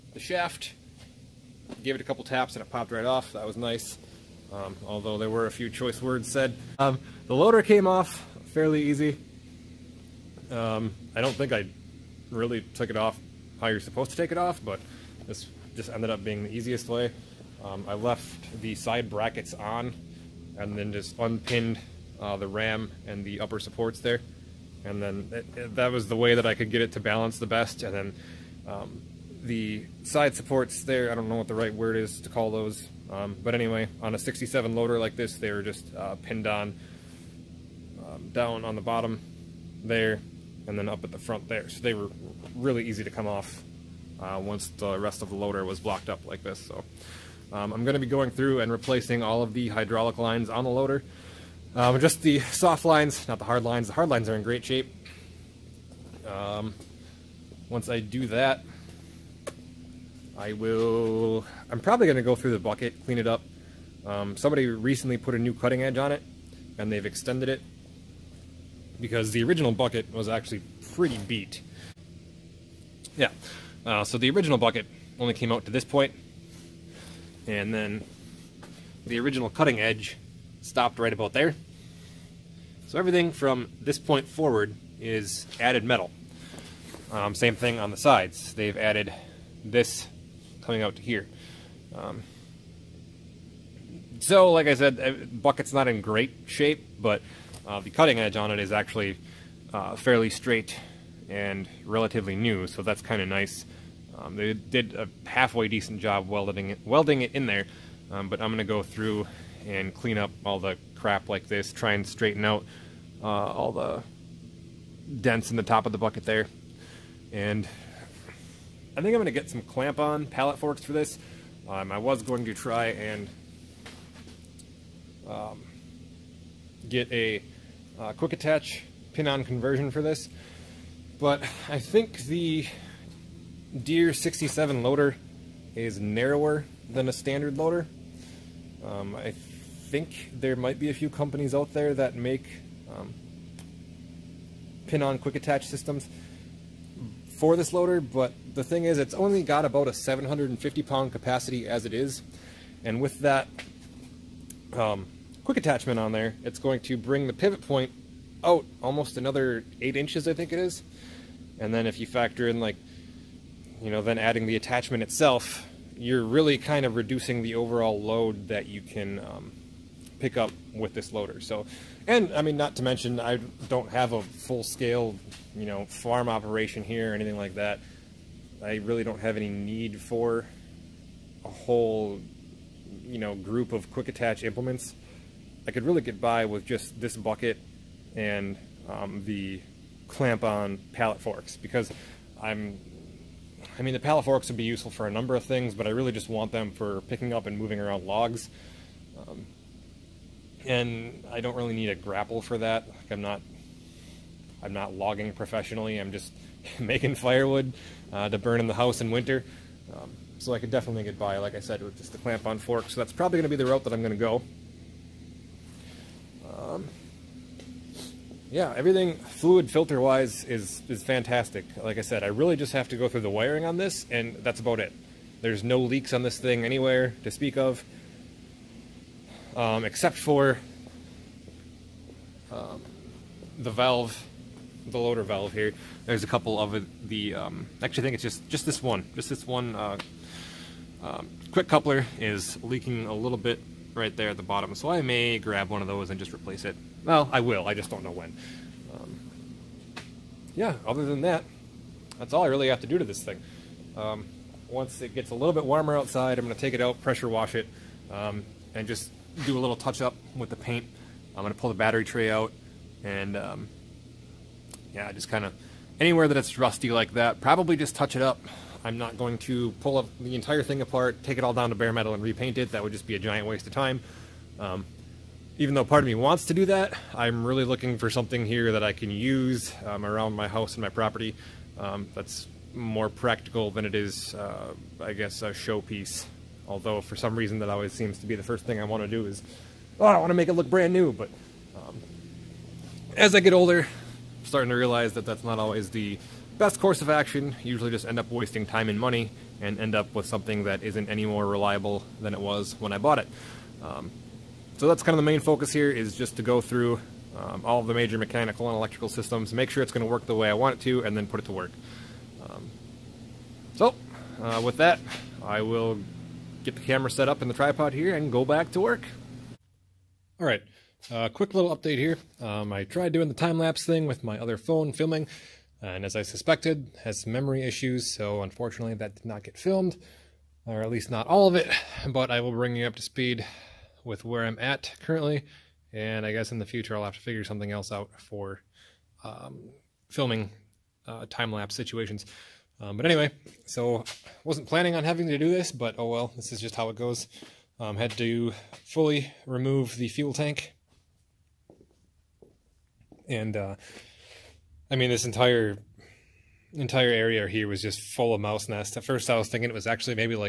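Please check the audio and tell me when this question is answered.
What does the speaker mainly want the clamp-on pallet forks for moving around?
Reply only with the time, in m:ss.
3:18.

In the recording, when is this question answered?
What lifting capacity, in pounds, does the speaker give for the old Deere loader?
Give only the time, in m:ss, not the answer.
2:29.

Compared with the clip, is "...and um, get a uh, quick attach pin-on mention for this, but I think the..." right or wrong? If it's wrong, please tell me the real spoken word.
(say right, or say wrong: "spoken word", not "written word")
wrong: "conversion", not "mention".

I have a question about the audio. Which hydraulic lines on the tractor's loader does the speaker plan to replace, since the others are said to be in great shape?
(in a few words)
Soft lines.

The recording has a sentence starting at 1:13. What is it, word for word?
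Yeah, uh, so the original bucket only came out to this point, and then the original cutting edge stopped right about there.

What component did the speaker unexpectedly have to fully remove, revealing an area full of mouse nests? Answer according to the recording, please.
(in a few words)
Fuel tank.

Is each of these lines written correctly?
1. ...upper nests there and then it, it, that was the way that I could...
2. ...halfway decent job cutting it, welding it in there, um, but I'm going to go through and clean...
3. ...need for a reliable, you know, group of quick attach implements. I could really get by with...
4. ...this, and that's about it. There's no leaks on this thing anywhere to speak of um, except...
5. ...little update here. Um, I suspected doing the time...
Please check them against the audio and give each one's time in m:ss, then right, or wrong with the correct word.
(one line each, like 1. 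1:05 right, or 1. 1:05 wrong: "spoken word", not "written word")
1. 0:23 wrong: "supports", not "nests"
2. 1:45 wrong: "welding", not "cutting"
3. 2:59 wrong: "whole", not "reliable"
4. 3:43 right
5. 5:21 wrong: "tried", not "suspected".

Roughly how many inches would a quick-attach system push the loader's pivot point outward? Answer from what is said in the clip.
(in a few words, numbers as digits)
8 inches.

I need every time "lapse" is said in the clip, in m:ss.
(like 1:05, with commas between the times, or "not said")
5:23, 5:41.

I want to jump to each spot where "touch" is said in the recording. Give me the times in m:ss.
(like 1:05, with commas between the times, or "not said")
4:19, 4:27.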